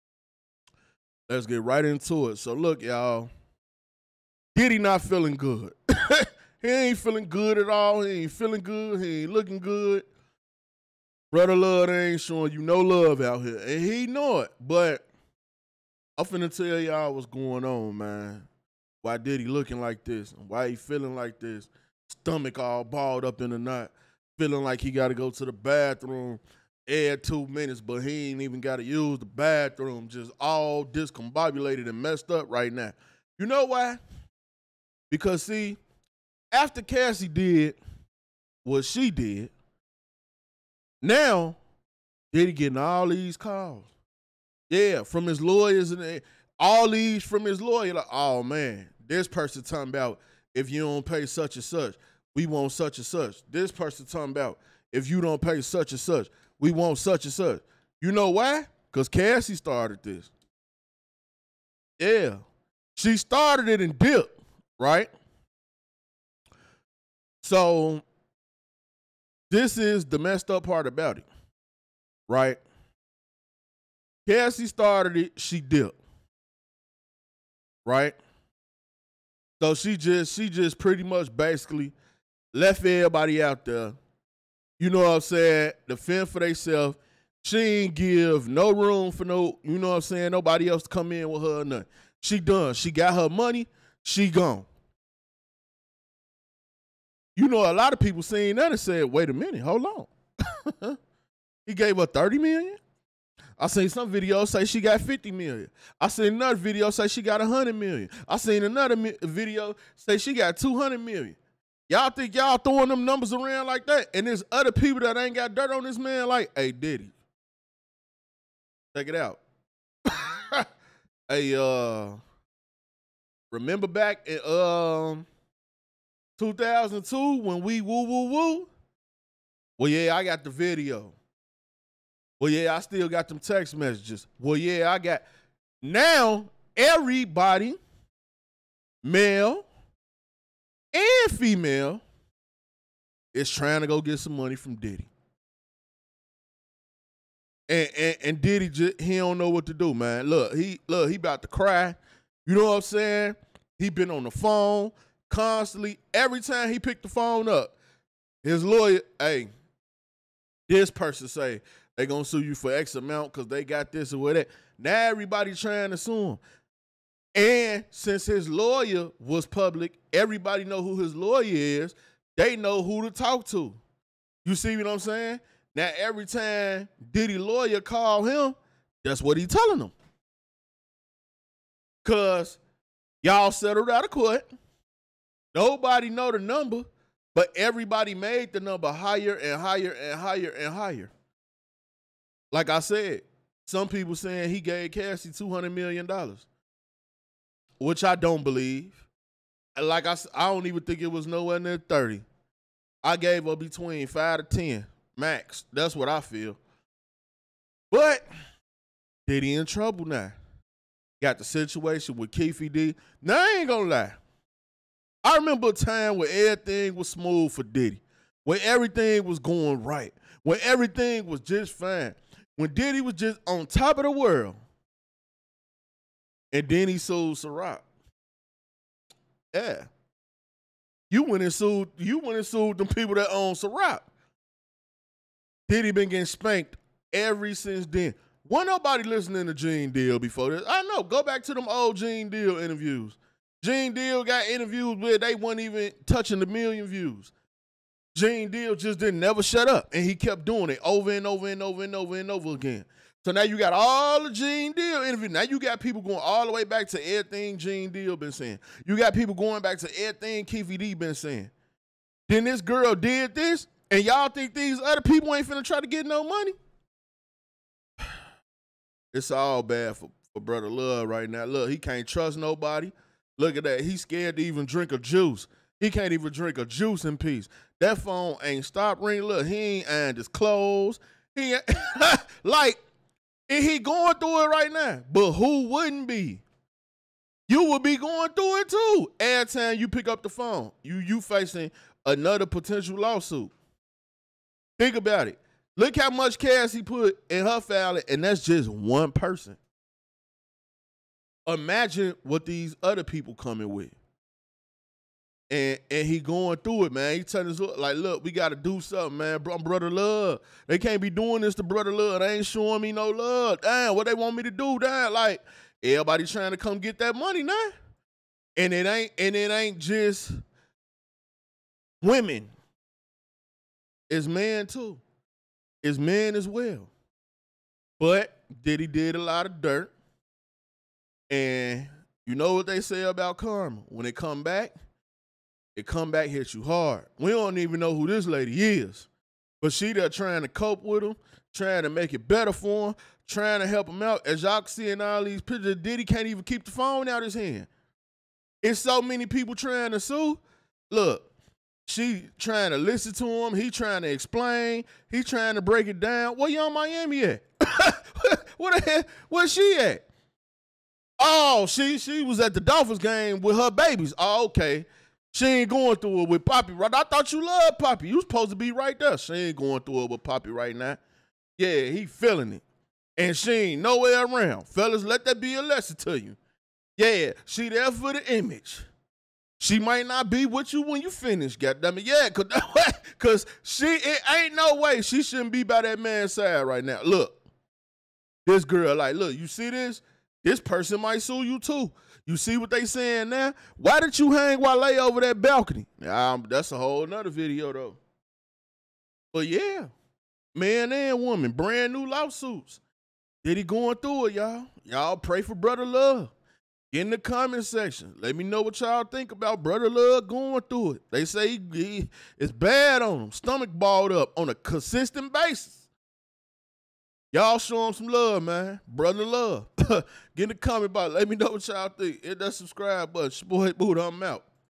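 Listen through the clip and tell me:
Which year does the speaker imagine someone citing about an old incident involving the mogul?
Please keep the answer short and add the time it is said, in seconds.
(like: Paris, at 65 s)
2002, at 126 s.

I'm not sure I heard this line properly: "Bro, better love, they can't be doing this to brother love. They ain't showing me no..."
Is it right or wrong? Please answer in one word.
wrong.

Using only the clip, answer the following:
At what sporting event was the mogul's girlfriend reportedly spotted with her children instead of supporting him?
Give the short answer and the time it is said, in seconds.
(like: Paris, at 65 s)
the Dolphins game, at 362 s.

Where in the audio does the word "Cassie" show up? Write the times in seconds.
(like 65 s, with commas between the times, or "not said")
36 s, 59 s, 74 s, 194 s.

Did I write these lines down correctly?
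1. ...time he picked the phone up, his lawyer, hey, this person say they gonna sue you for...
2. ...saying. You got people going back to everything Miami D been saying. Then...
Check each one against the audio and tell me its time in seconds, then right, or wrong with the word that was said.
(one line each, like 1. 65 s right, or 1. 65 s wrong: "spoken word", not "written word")
1. 156 s right
2. 258 s wrong: "Keffe", not "Miami".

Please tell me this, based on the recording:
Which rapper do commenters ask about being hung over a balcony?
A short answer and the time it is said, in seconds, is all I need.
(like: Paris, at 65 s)
Wale, at 394 s.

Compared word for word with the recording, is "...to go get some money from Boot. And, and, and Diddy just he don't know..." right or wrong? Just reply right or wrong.
wrong.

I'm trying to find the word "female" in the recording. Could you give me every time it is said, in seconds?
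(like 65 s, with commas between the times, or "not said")
141 s.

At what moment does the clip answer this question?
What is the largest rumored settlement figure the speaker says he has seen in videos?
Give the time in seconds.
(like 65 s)
110 s.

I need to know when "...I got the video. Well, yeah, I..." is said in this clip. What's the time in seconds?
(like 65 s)
130 s.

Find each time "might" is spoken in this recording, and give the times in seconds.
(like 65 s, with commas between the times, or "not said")
379 s, 391 s.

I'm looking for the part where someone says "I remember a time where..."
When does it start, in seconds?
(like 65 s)
215 s.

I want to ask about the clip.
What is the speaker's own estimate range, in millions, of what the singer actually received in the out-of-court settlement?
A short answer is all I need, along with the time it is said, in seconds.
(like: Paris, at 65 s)
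5 to 10, at 204 s.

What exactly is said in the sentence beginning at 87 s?
She ain't give no room for no, you know what I'm saying, nobody else to come in with her or nothing.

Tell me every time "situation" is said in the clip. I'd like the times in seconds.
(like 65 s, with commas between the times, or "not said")
211 s.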